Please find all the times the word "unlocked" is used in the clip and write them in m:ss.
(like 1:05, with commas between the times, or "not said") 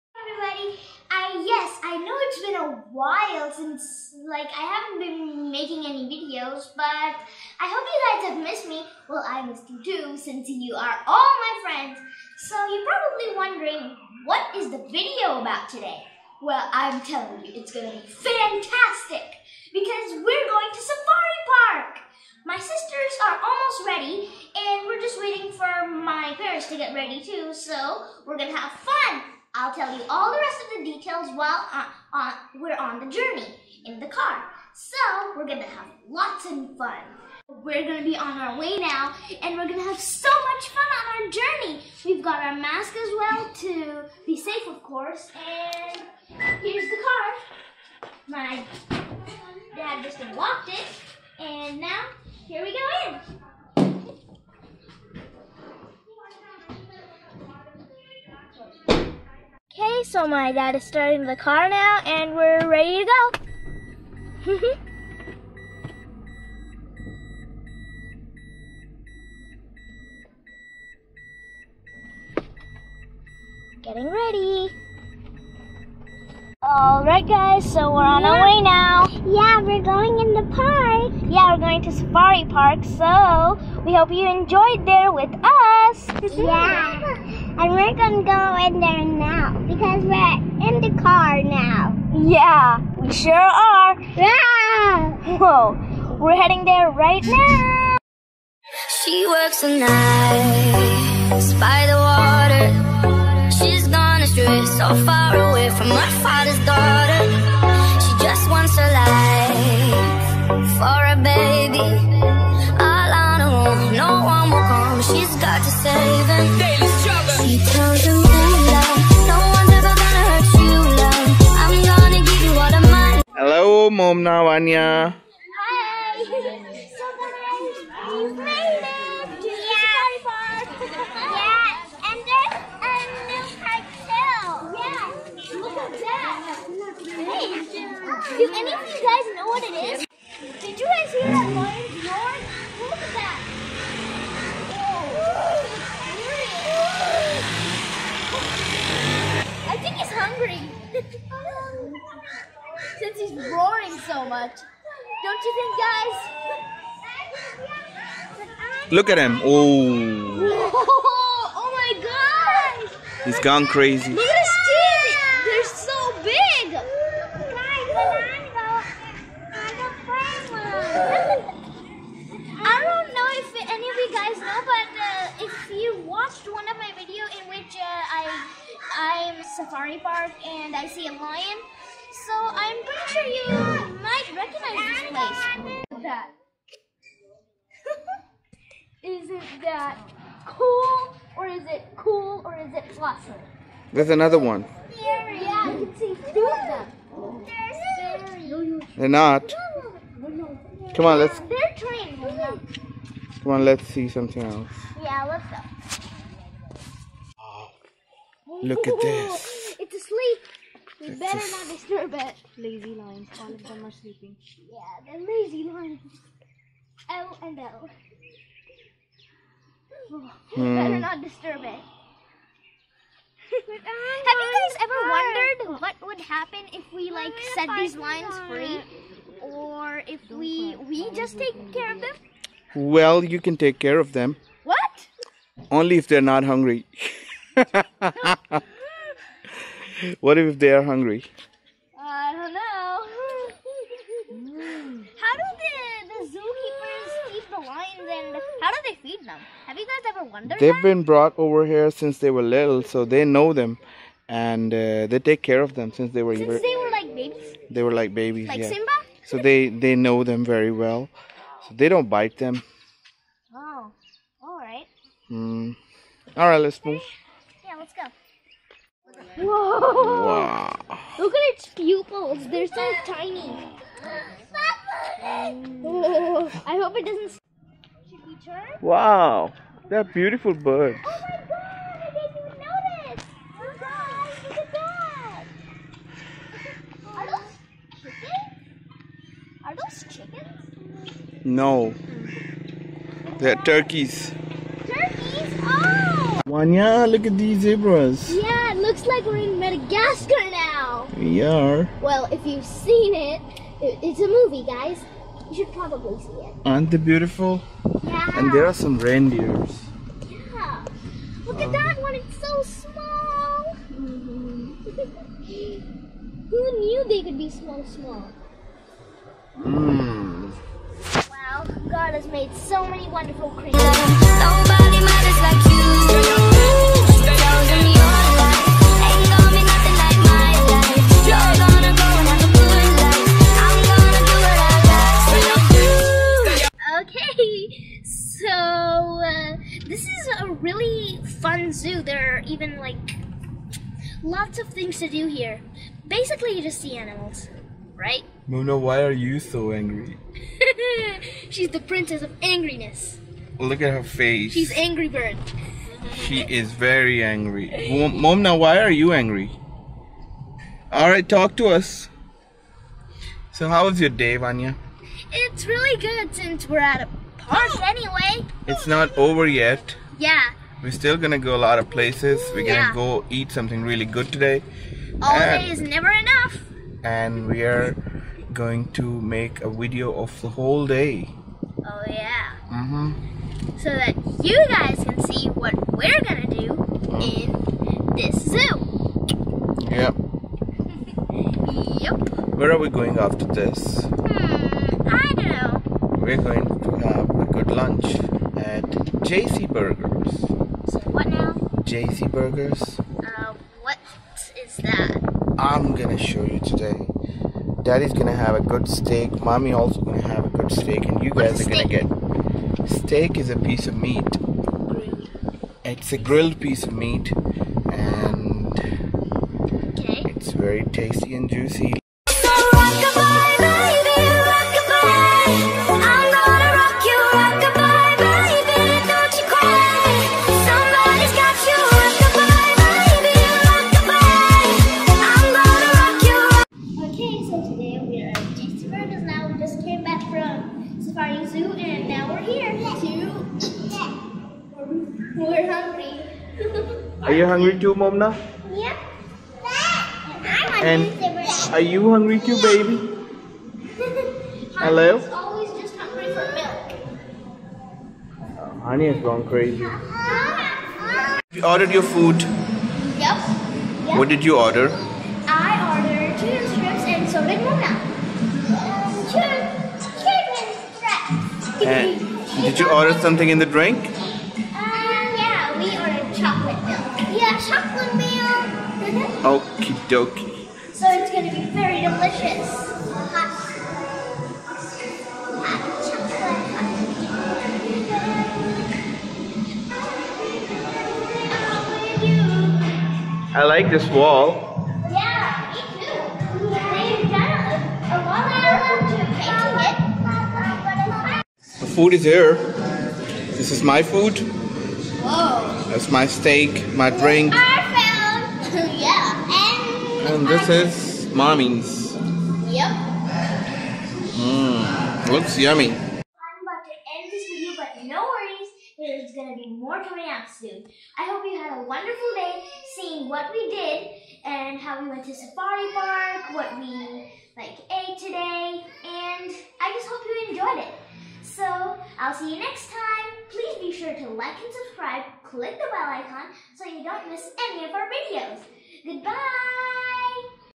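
0:50.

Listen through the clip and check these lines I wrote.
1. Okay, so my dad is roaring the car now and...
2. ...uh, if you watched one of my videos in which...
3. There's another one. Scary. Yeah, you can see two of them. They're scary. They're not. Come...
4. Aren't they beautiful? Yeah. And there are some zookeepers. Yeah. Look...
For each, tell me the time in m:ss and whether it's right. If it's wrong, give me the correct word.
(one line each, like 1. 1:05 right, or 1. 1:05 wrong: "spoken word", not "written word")
1. 0:59 wrong: "starting", not "roaring"
2. 2:54 right
3. 3:13 right
4. 5:06 wrong: "reindeers", not "zookeepers".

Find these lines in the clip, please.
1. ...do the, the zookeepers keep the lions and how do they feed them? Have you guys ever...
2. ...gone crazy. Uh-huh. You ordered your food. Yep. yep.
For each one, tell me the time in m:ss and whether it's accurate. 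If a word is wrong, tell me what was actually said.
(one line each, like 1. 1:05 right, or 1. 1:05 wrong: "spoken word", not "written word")
1. 4:05 right
2. 7:39 right.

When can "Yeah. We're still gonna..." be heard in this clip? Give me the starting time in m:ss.
6:10.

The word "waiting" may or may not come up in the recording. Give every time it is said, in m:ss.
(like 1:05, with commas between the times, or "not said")
0:25.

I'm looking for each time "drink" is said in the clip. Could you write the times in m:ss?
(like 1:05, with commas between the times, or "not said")
7:53, 8:27.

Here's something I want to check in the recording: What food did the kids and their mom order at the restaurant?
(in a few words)
Chicken strips.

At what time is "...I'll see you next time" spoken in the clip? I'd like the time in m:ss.
8:52.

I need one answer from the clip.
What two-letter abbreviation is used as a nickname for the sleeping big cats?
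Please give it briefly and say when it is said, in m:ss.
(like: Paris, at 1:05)
L and L, at 3:37.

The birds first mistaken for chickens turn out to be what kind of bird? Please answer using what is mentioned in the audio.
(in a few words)
Turkeys.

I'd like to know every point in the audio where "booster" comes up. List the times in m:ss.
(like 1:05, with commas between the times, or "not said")
not said.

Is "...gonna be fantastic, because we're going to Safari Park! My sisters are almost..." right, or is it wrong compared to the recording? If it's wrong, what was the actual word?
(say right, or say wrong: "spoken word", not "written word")
right.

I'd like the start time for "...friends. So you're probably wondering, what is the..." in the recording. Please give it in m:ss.
0:11.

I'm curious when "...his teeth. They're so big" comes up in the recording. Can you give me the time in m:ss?
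2:44.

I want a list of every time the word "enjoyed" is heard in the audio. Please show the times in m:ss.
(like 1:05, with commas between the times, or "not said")
1:24, 8:50.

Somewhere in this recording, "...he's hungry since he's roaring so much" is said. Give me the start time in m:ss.
2:29.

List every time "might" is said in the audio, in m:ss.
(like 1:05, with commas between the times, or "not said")
3:04.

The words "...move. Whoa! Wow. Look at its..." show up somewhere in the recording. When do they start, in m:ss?
4:26.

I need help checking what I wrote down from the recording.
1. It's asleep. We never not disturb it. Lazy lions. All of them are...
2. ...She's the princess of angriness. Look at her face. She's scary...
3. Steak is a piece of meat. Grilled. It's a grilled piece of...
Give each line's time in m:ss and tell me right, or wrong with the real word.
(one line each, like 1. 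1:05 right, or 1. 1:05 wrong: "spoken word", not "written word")
1. 3:29 wrong: "better", not "never"
2. 5:51 wrong: "angry", not "scary"
3. 6:52 right.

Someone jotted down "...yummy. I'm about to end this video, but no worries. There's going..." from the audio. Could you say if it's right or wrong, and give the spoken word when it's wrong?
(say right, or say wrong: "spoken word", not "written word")
right.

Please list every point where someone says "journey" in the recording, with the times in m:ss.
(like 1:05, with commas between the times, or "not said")
0:33, 0:41.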